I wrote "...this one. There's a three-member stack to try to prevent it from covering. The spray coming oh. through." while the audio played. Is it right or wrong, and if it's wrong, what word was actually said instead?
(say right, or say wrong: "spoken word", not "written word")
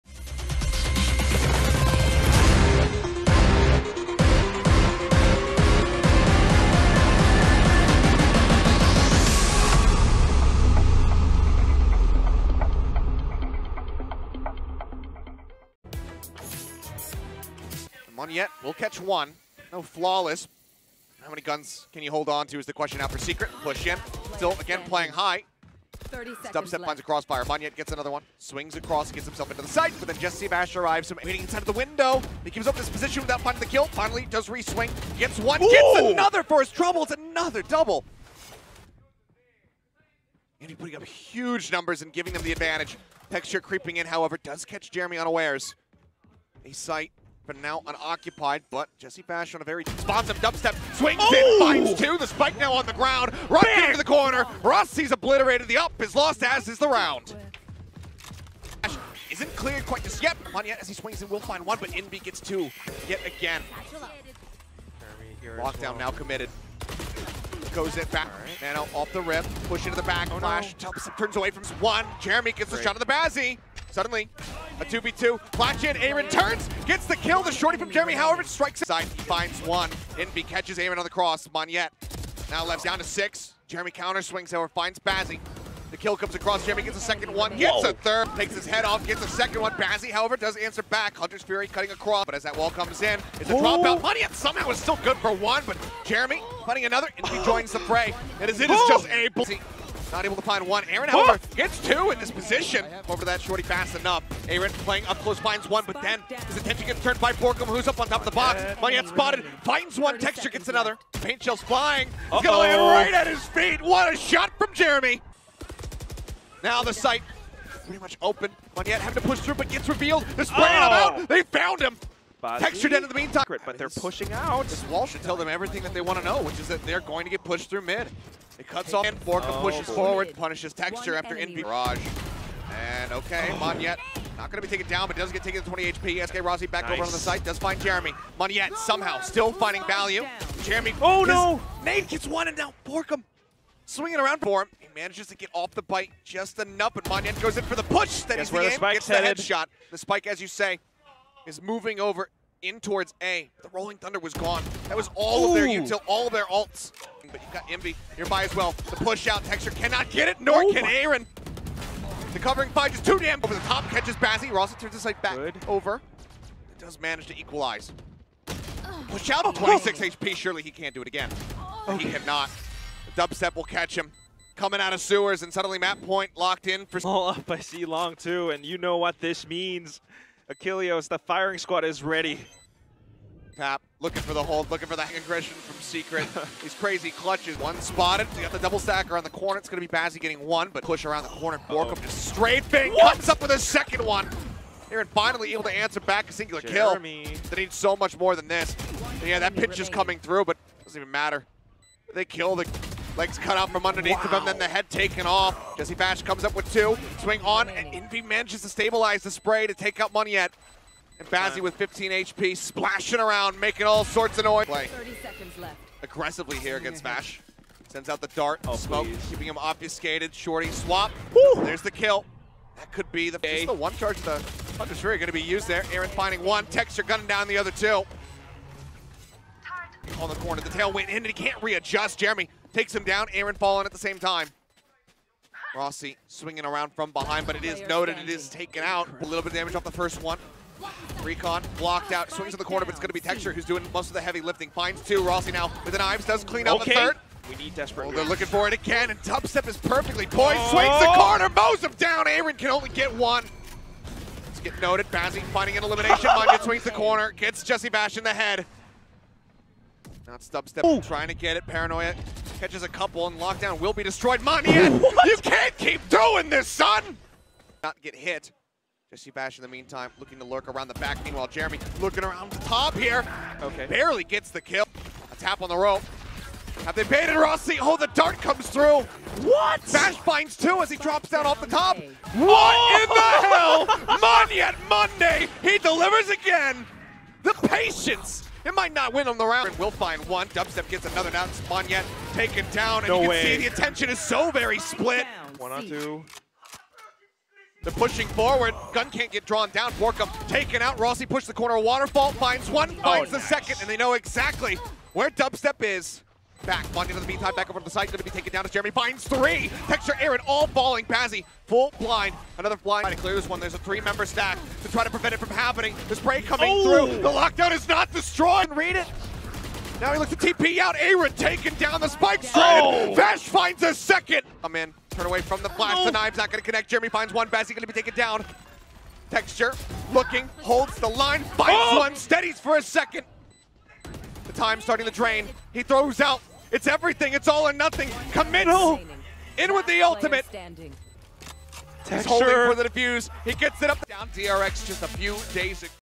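wrong: "happening", not "covering".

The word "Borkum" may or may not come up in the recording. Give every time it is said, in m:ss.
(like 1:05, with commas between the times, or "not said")
1:47, 2:22, 3:11, 4:59.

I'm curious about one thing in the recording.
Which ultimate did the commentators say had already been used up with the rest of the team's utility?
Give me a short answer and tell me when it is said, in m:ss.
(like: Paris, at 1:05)
Rolling Thunder, at 2:33.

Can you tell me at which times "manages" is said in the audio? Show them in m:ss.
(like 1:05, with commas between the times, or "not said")
2:24, 2:46, 3:28.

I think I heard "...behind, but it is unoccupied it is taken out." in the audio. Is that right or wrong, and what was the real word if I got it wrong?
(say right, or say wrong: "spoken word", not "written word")
wrong: "noted", not "unoccupied".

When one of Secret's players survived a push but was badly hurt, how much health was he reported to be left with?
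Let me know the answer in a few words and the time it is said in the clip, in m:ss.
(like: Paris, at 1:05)
20 HP, at 2:15.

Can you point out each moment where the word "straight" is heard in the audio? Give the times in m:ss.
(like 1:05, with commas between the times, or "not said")
3:12, 5:22.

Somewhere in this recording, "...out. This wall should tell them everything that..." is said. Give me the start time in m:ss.
2:04.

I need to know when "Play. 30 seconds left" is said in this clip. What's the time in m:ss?
3:34.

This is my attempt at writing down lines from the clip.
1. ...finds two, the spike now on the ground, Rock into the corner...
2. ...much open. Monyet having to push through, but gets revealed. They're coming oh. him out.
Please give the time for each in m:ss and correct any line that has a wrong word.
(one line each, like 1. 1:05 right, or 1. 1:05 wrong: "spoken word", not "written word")
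1. 0:51 right
2. 1:57 wrong: "spraying", not "coming".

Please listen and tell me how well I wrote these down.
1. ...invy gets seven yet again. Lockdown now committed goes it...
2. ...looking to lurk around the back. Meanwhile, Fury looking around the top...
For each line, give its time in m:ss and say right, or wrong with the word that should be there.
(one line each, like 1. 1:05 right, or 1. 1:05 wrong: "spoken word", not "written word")
1. 1:01 wrong: "two", not "seven"
2. 4:30 wrong: "Jeremy", not "Fury".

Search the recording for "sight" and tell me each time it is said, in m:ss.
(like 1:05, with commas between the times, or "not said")
0:46, 2:45.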